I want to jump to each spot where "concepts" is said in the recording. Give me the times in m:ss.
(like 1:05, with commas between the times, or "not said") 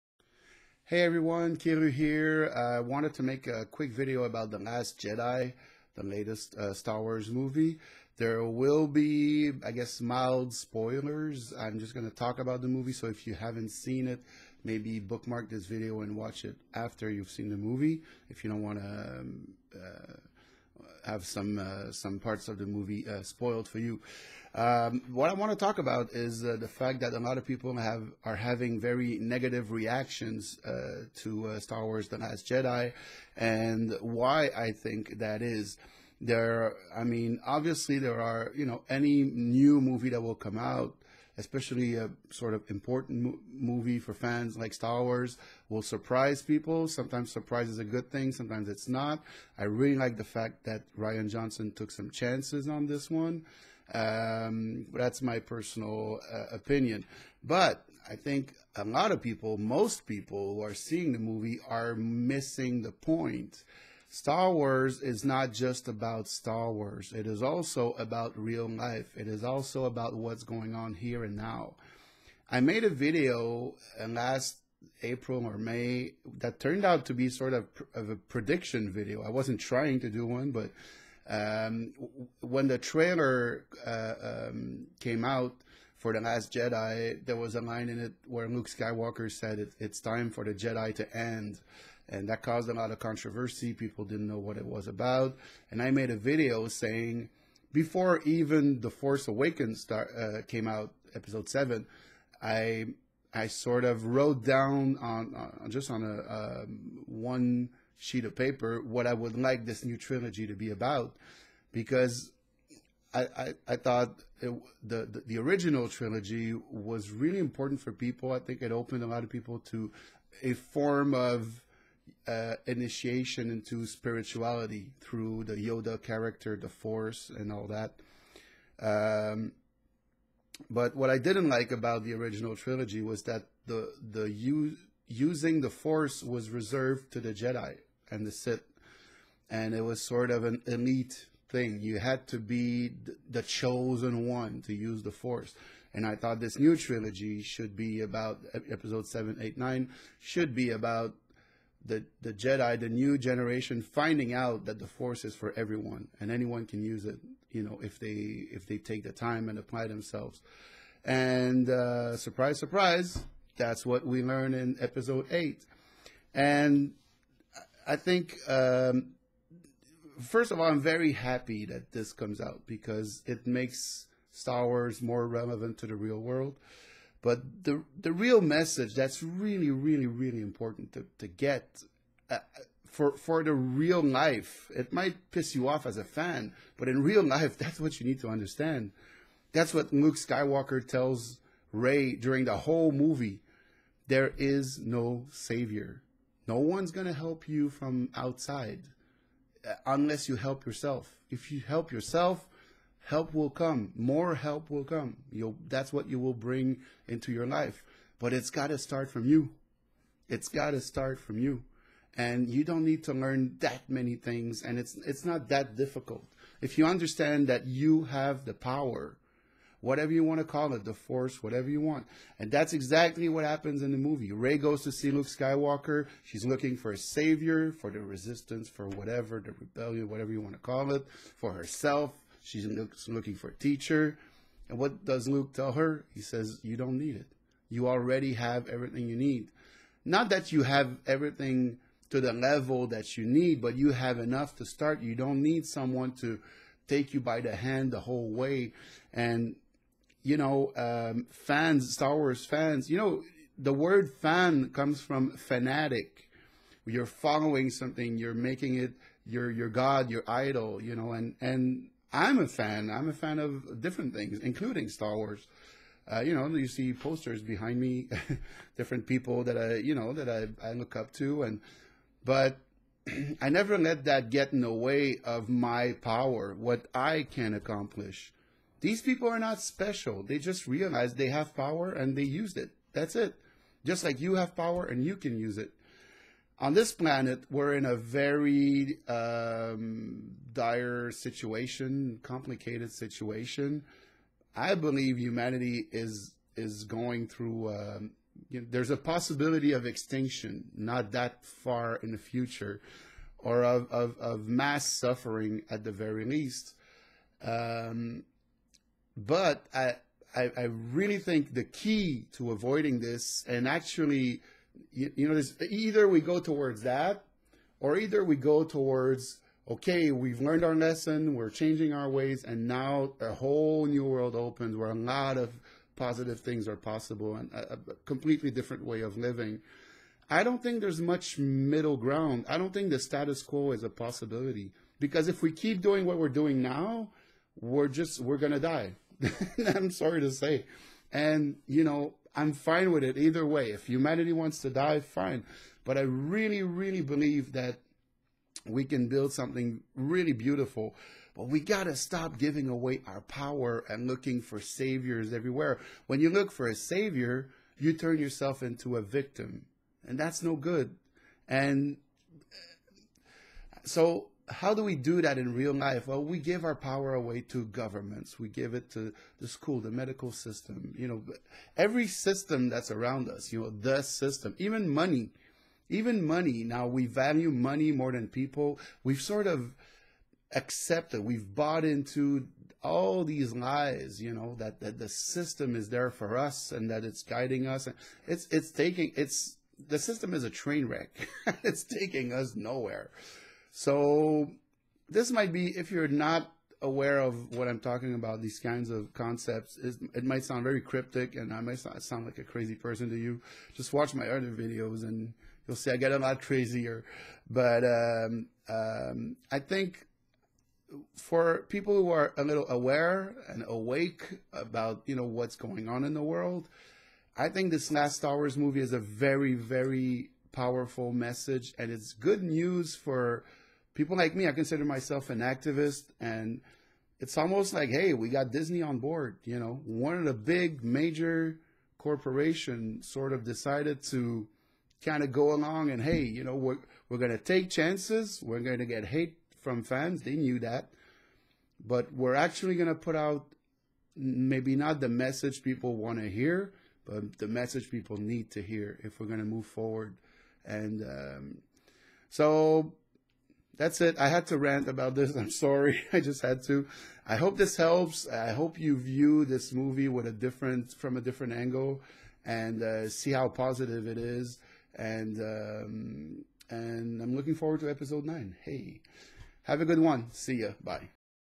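6:39.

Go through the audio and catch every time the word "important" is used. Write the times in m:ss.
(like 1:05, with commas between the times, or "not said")
0:42, 1:57, 3:00.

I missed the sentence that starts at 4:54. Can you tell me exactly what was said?
I believe humanity is is going through.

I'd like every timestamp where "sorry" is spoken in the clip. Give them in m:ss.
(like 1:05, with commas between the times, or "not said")
5:39, 7:35.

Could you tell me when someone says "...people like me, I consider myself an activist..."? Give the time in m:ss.
7:03.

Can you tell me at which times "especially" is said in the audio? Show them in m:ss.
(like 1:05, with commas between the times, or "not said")
0:41.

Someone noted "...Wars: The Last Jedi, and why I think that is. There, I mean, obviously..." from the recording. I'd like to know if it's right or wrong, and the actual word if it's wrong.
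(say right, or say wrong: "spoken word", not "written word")
right.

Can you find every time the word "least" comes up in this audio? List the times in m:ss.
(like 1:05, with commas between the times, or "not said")
5:06.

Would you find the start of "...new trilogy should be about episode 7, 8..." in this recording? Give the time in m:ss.
2:26.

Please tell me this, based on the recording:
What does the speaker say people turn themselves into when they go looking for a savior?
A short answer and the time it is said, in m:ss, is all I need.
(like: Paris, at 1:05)
a victim, at 5:58.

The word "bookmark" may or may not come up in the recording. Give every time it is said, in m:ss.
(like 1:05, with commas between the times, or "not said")
0:14.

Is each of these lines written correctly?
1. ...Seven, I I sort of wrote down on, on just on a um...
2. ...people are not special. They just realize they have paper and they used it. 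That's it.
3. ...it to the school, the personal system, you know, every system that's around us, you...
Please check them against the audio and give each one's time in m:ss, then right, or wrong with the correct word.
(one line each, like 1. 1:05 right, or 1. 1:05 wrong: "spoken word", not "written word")
1. 1:41 right
2. 4:39 wrong: "power", not "paper"
3. 6:08 wrong: "medical", not "personal".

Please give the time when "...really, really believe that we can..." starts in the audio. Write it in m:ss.
5:46.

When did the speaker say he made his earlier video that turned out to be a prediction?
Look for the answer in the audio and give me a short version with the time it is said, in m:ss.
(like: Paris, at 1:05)
April or May, at 1:15.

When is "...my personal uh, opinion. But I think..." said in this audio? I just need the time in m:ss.
0:55.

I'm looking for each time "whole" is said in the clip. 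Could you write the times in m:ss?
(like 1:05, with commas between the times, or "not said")
3:12, 4:08, 5:23.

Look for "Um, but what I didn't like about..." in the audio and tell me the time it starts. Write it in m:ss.
2:08.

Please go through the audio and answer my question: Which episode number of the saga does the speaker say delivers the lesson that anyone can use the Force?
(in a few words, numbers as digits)
8.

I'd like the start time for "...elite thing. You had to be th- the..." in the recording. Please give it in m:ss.
2:20.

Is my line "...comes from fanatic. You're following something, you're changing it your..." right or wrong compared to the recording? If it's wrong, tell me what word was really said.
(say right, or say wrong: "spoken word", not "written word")
wrong: "making", not "changing".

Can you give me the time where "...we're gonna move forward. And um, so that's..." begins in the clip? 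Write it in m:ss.
7:29.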